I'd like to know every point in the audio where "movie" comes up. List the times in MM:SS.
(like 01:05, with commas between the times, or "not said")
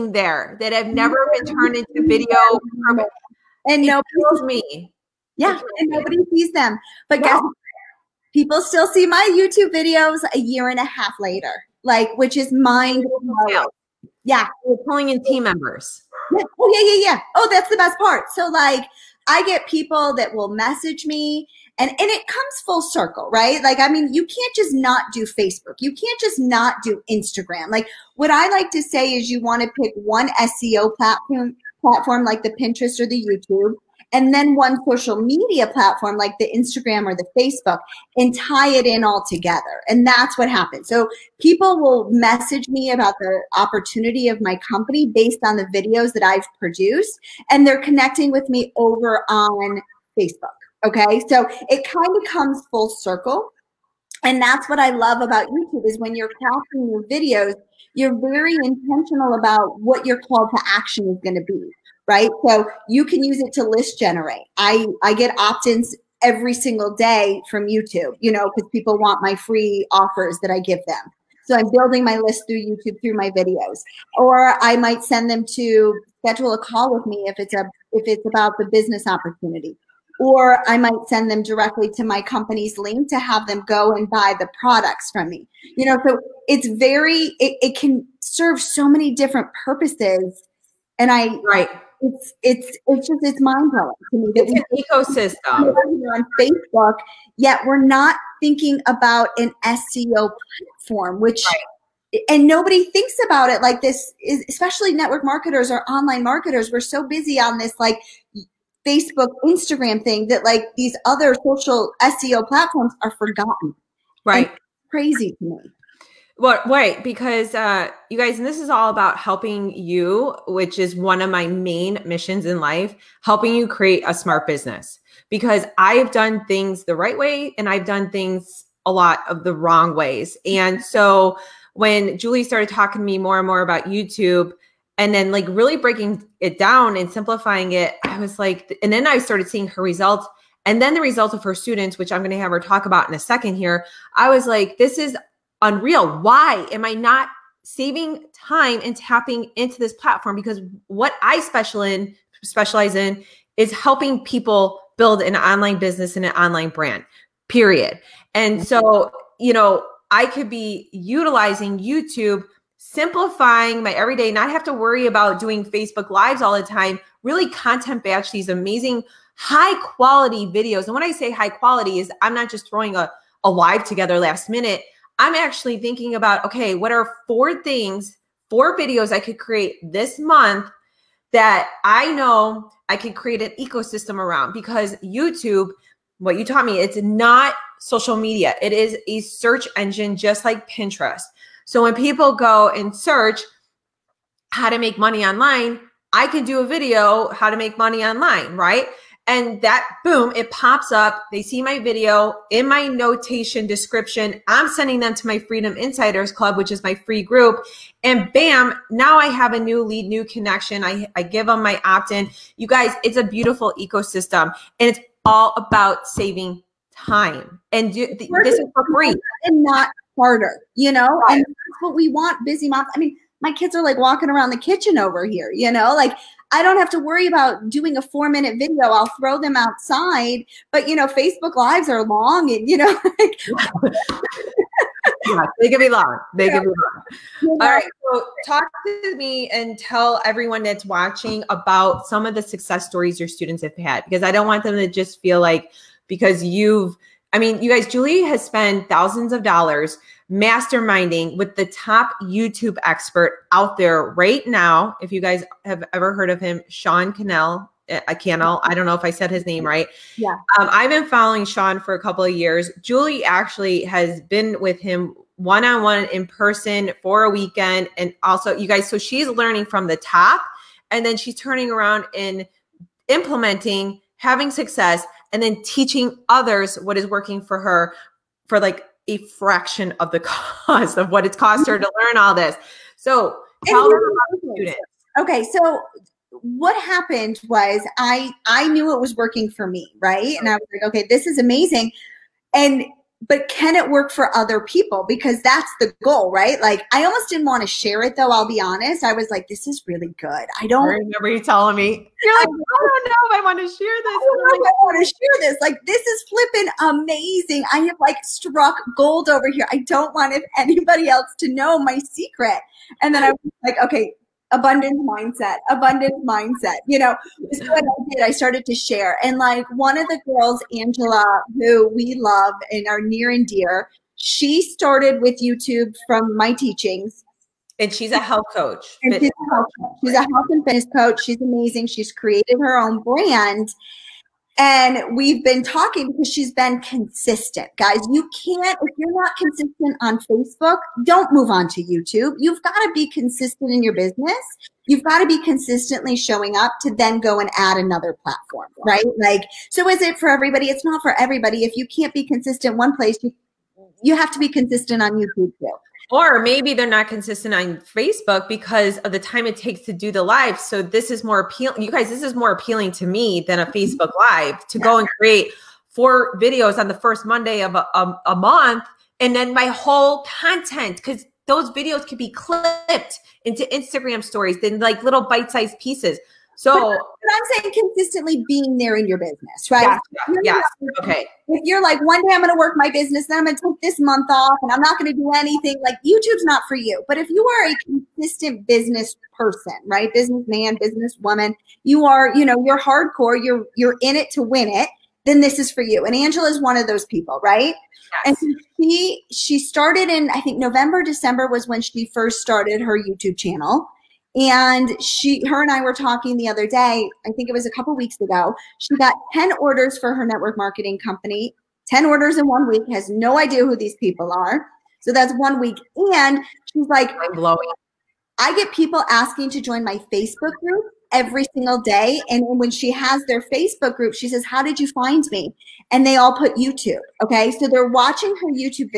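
not said.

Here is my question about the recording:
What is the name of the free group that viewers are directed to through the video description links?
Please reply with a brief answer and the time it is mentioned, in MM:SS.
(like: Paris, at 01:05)
Freedom Insiders Club, at 03:25.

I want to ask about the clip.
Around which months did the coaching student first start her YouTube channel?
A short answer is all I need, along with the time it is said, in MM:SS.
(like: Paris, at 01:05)
November, December, at 06:40.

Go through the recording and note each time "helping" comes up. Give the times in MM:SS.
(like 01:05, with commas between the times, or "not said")
01:59, 02:03, 02:33.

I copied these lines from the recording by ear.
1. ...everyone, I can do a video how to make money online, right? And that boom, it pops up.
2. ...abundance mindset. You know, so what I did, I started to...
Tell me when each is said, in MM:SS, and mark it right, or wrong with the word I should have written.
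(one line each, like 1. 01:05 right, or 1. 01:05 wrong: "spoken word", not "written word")
1. 03:15 wrong: "online", not "everyone"
2. 05:15 right.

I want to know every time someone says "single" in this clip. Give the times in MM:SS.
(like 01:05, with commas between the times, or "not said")
01:06, 07:01.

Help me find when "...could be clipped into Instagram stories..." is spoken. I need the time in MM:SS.
06:12.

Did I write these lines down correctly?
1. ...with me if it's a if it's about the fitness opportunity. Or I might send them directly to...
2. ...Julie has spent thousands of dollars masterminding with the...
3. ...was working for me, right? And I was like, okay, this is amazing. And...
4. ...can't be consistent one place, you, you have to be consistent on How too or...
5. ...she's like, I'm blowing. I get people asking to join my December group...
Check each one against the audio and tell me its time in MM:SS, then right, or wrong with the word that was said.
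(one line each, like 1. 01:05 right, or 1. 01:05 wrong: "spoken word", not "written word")
1. 01:16 wrong: "business", not "fitness"
2. 04:07 right
3. 04:49 right
4. 05:51 wrong: "YouTube", not "How"
5. 06:56 wrong: "Facebook", not "December".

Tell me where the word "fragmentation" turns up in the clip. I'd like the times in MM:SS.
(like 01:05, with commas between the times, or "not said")
not said.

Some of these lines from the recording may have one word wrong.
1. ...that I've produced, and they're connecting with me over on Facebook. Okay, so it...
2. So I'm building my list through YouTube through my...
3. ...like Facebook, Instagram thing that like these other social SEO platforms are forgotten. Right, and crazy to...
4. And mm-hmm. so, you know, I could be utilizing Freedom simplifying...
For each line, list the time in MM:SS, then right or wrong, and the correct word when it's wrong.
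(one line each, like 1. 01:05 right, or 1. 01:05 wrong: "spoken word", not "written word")
1. 00:46 right
2. 01:11 right
3. 01:47 right
4. 02:38 wrong: "YouTube", not "Freedom".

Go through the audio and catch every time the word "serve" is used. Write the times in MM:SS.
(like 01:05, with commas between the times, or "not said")
01:28.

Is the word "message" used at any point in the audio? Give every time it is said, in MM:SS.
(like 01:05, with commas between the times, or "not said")
00:20, 00:42.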